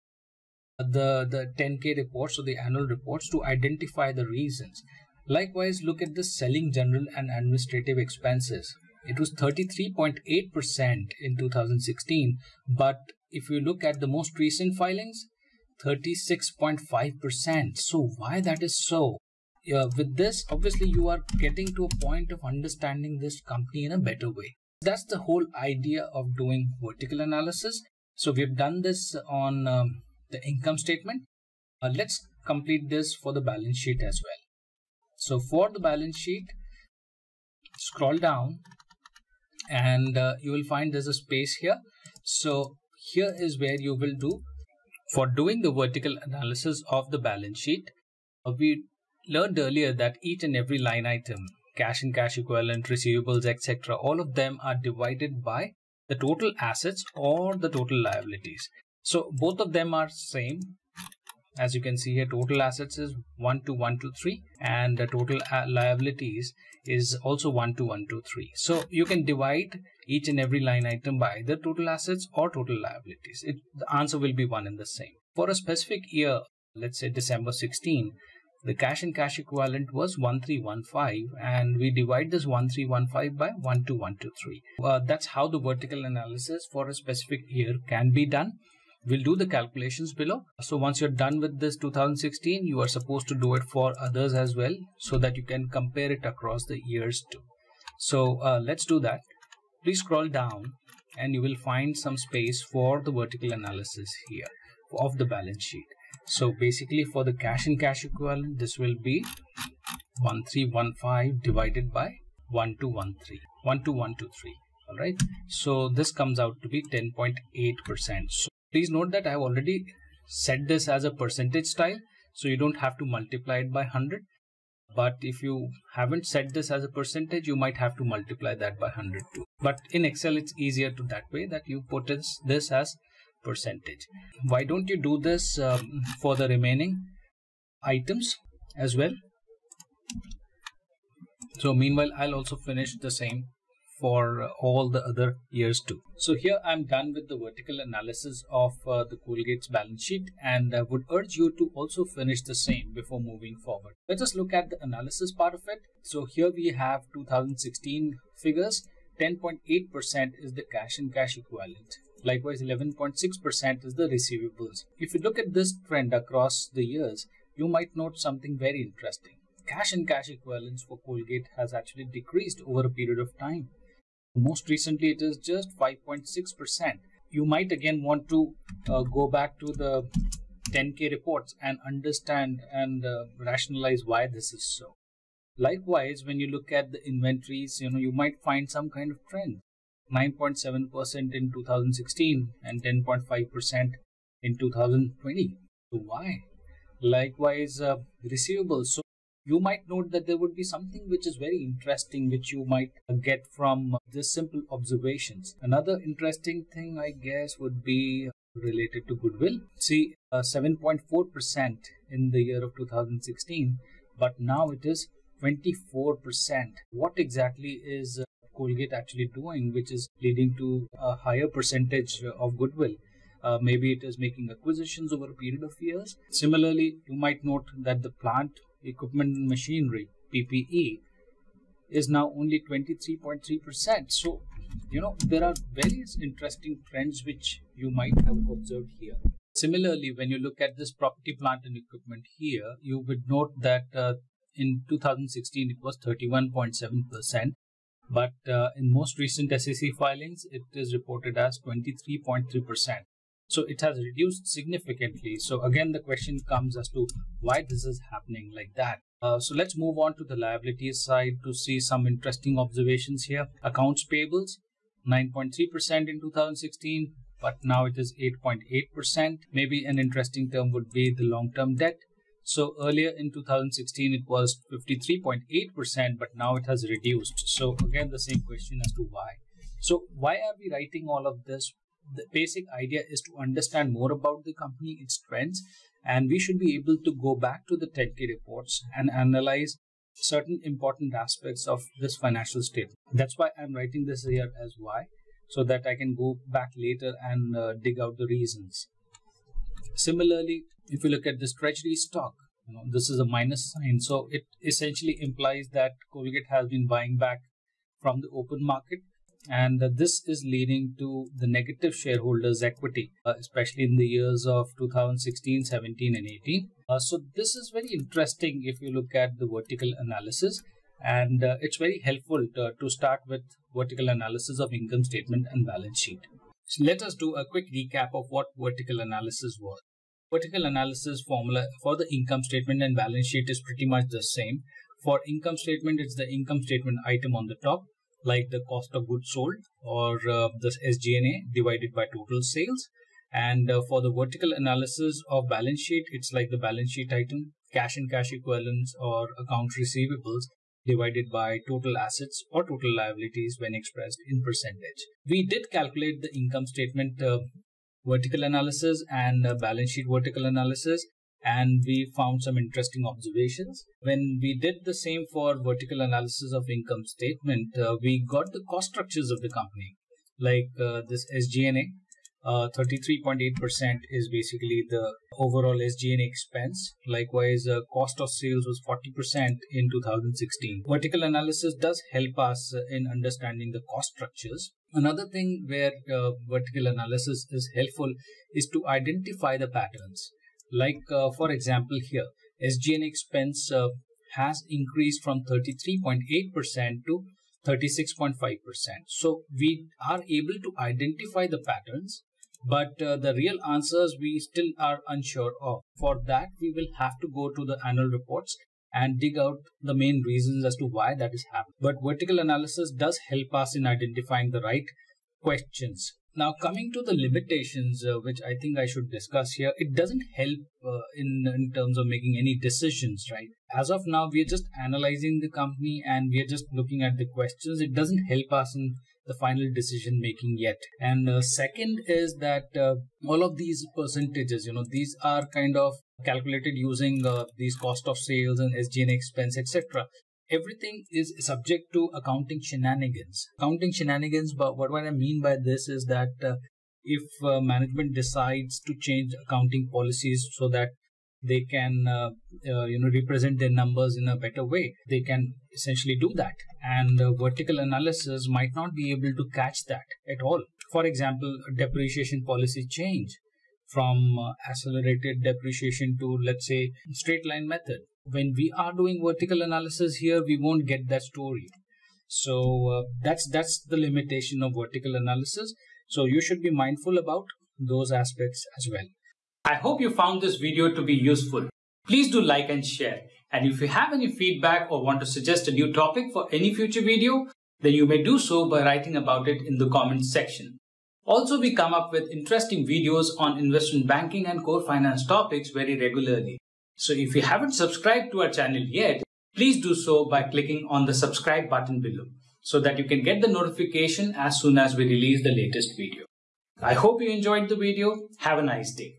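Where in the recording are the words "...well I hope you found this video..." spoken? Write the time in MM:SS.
07:58.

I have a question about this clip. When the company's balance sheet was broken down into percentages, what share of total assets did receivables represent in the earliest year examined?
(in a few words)
11.6%.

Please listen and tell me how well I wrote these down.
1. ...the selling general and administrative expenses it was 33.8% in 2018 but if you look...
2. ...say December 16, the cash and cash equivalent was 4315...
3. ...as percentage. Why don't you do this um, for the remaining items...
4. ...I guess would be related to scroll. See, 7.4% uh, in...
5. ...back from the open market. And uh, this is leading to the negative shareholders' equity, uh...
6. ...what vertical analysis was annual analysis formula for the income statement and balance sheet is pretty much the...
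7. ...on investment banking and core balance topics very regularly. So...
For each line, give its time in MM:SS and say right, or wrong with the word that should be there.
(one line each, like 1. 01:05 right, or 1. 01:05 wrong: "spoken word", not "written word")
1. 00:06 wrong: "2016", not "2018"
2. 01:16 wrong: "1315", not "4315"
3. 02:12 right
4. 03:26 wrong: "goodwill", not "scroll"
5. 05:07 right
6. 05:28 wrong: "vertical", not "annual"
7. 08:13 wrong: "finance", not "balance".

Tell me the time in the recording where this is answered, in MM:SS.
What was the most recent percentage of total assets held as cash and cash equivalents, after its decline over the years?
02:55.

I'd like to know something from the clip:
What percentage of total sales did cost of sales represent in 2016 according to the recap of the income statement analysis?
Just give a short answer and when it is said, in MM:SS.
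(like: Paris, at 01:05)
40%, at 06:18.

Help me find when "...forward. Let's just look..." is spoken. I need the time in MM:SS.
02:33.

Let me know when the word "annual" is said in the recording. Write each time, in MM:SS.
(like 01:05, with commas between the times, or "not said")
00:02, 06:47.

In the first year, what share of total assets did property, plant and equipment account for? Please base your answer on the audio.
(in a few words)
31.7%.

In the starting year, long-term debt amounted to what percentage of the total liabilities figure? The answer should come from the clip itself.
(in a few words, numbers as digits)
53.8%.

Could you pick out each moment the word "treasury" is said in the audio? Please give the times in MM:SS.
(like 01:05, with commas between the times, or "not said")
05:01.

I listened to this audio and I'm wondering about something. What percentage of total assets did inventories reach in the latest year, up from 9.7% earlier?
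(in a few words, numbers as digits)
10.5%.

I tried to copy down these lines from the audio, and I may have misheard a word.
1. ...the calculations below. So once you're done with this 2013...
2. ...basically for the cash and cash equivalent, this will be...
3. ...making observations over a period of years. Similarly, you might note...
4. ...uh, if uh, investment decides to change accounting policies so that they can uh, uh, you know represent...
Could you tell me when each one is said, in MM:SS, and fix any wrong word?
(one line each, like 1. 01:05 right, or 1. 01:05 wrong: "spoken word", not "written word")
1. 01:29 wrong: "2016", not "2013"
2. 01:46 right
3. 03:44 wrong: "acquisitions", not "observations"
4. 07:26 wrong: "management", not "investment".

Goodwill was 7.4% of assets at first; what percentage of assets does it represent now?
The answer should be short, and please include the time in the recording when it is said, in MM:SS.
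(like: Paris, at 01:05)
24%, at 03:35.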